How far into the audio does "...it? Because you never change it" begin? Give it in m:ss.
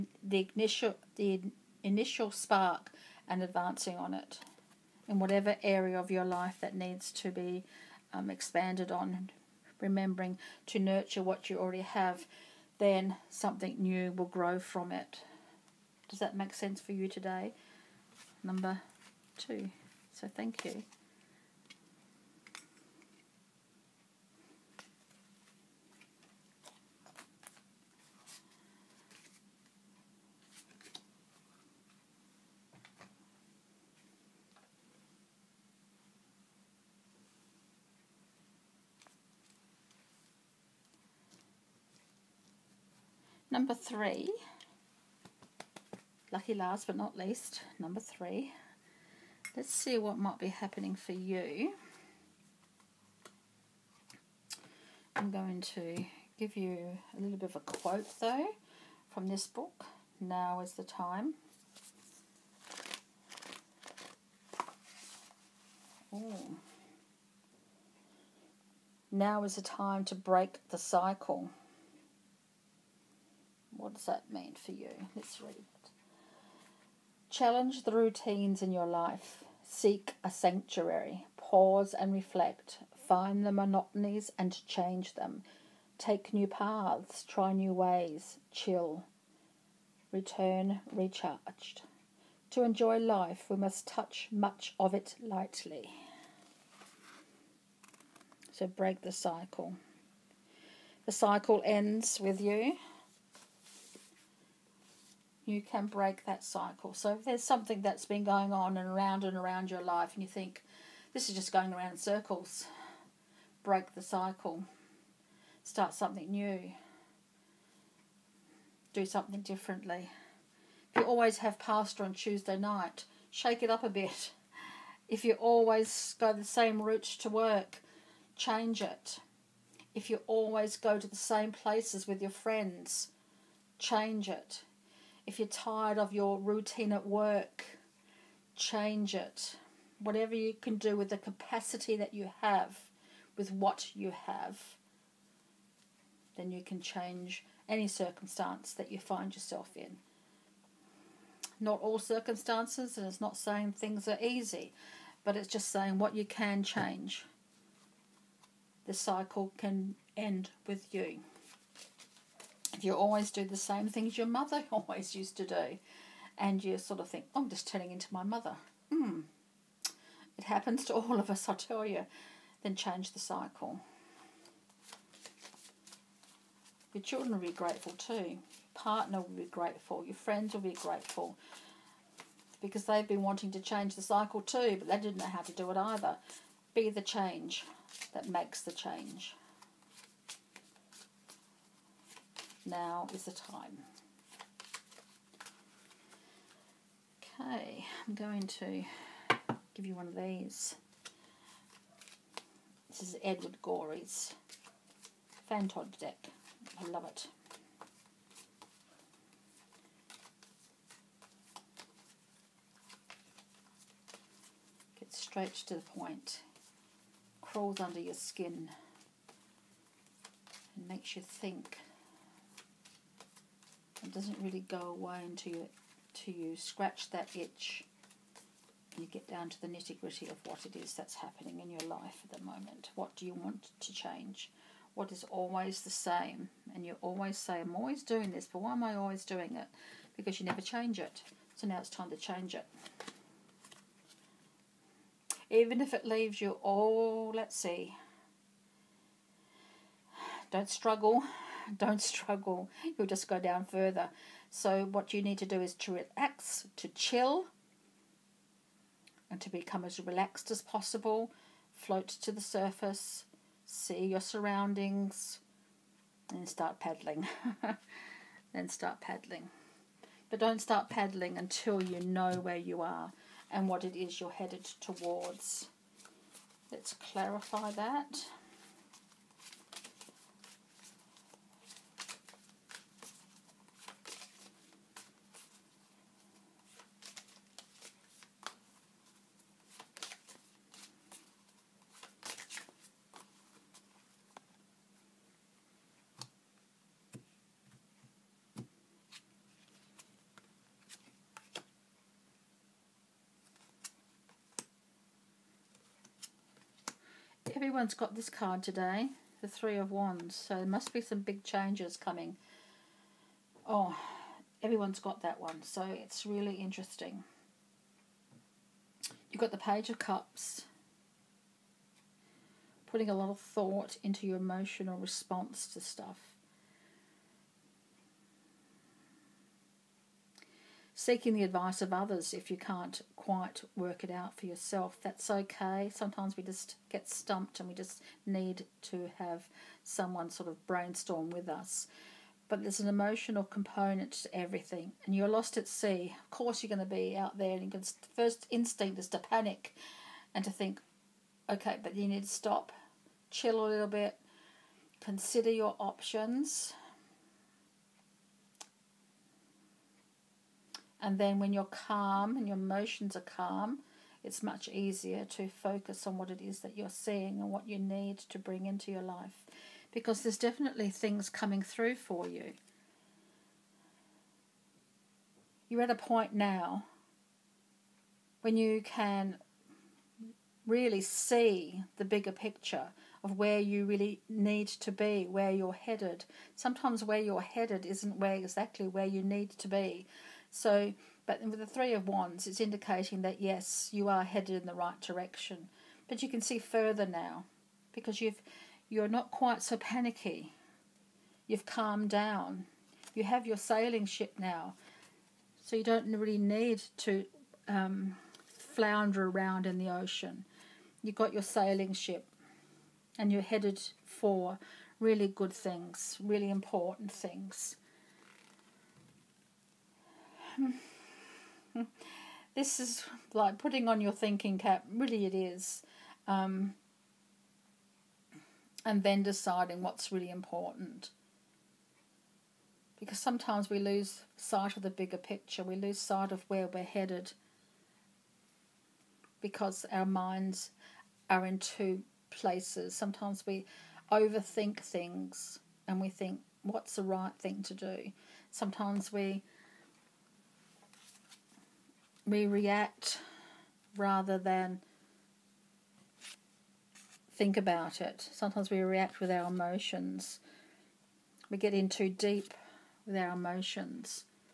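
3:59.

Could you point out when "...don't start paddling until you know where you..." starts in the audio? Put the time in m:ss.
4:30.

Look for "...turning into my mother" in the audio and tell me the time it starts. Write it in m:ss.
2:47.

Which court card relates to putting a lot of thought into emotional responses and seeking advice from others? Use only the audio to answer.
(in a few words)
Page of Cups.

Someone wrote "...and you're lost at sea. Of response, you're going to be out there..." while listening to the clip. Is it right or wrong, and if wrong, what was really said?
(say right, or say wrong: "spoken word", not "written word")
wrong: "course", not "response".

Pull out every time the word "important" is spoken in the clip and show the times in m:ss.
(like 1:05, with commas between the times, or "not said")
6:56, 7:10.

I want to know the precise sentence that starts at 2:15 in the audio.
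If you're tired of your routine at work, change it.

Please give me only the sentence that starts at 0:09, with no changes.
Remembering to nurture what you already have, then something new will grow from it.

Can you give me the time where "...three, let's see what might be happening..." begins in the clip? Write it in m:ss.
0:47.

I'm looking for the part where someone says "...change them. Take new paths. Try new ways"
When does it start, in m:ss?
1:24.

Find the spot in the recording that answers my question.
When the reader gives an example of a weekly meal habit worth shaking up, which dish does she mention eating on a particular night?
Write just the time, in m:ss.
2:01.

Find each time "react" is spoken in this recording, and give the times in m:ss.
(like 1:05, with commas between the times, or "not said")
7:32, 7:38.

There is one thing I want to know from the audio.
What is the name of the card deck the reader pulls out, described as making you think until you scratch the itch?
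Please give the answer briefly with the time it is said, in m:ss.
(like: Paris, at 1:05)
Fantod deck, at 3:25.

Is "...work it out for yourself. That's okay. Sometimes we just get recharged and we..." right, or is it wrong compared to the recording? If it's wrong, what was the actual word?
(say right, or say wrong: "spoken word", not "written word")
wrong: "stumped", not "recharged".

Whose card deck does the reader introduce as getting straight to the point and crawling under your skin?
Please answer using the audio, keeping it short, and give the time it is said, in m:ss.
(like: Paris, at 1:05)
Edward Gorey, at 3:23.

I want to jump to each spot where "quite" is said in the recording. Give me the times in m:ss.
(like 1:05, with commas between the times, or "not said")
5:33, 6:39.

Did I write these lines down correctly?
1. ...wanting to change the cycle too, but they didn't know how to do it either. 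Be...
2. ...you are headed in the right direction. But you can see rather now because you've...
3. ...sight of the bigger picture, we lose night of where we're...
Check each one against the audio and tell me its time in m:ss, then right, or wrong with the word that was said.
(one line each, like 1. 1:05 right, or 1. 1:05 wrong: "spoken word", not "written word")
1. 3:03 right
2. 6:33 wrong: "further", not "rather"
3. 7:14 wrong: "sight", not "night".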